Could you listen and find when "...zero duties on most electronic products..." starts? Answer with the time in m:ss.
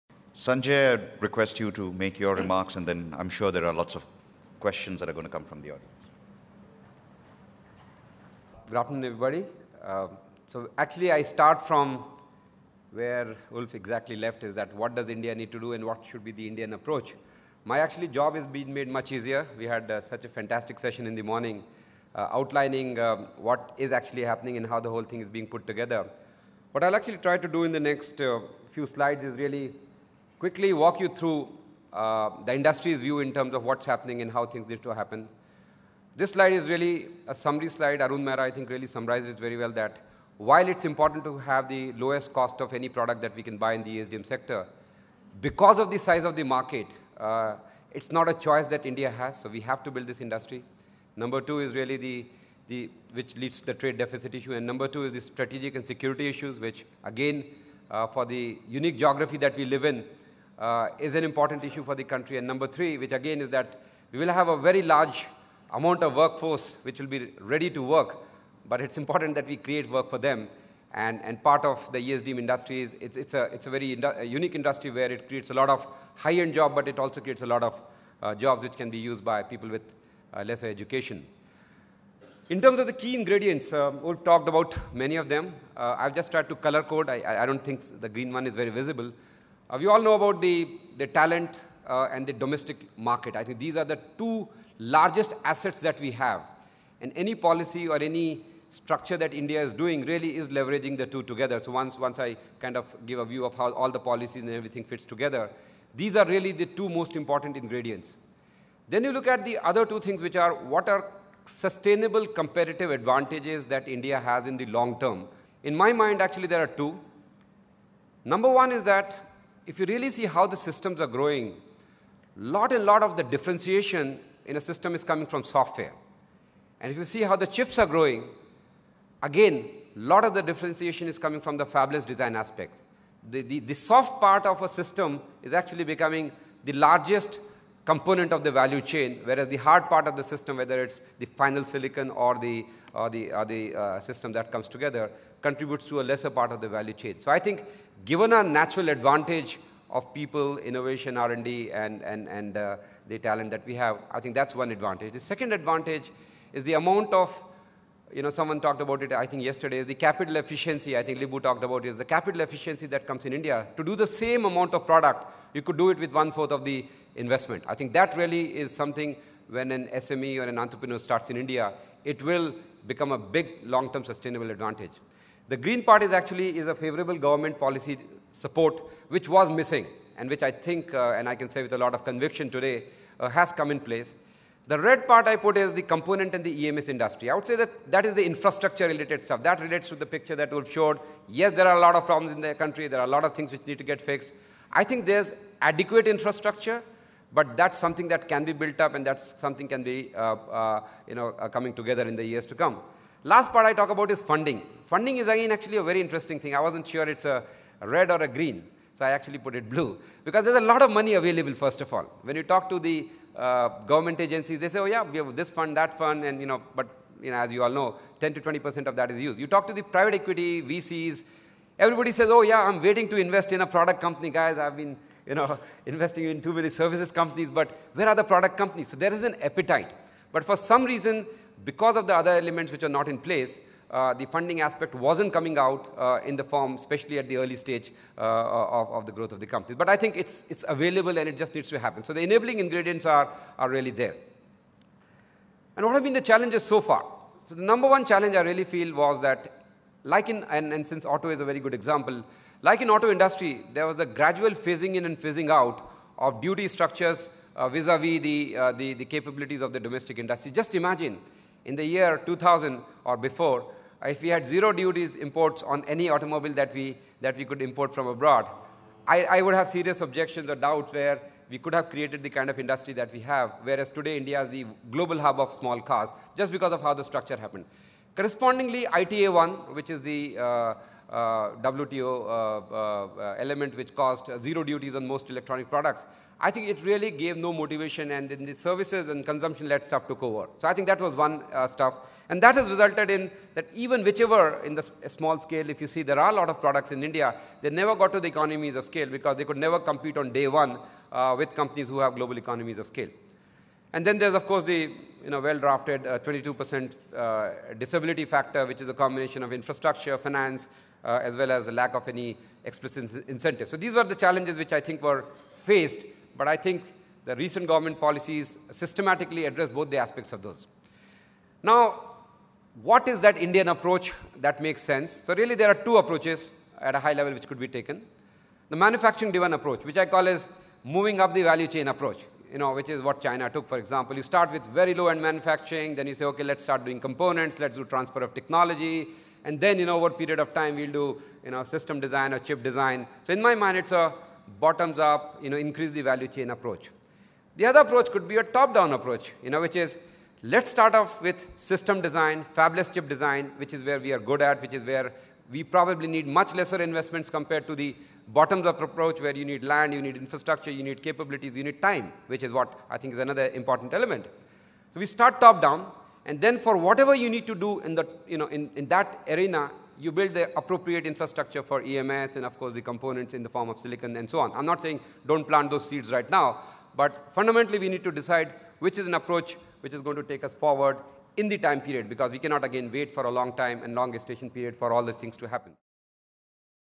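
4:44.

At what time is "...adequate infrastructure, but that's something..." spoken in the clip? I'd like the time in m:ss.
3:15.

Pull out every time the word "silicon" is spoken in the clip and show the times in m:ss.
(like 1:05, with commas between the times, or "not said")
2:21, 6:13.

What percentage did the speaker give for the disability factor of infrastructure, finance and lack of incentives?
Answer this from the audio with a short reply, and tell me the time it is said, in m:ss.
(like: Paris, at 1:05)
22%, at 5:06.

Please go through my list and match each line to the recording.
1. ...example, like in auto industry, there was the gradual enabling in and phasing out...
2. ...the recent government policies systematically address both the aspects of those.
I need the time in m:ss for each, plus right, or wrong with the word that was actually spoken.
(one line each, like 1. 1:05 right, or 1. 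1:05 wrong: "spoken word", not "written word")
1. 4:11 wrong: "phasing", not "enabling"
2. 5:17 right.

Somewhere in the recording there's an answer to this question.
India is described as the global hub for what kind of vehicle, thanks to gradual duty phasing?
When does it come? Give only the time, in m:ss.
4:35.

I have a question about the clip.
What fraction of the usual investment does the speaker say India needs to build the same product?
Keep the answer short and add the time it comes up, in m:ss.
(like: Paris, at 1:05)
one-fourth, at 2:46.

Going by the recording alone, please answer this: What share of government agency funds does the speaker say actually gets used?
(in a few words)
10 to 20 percent.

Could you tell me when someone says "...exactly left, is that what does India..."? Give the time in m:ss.
0:13.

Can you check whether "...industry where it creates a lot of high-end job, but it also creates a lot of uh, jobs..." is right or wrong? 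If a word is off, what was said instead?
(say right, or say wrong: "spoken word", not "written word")
right.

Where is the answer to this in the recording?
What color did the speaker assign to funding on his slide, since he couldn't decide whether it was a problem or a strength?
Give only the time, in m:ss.
3:29.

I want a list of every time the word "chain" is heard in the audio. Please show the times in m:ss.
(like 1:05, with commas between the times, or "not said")
2:18, 2:26, 5:31, 5:46.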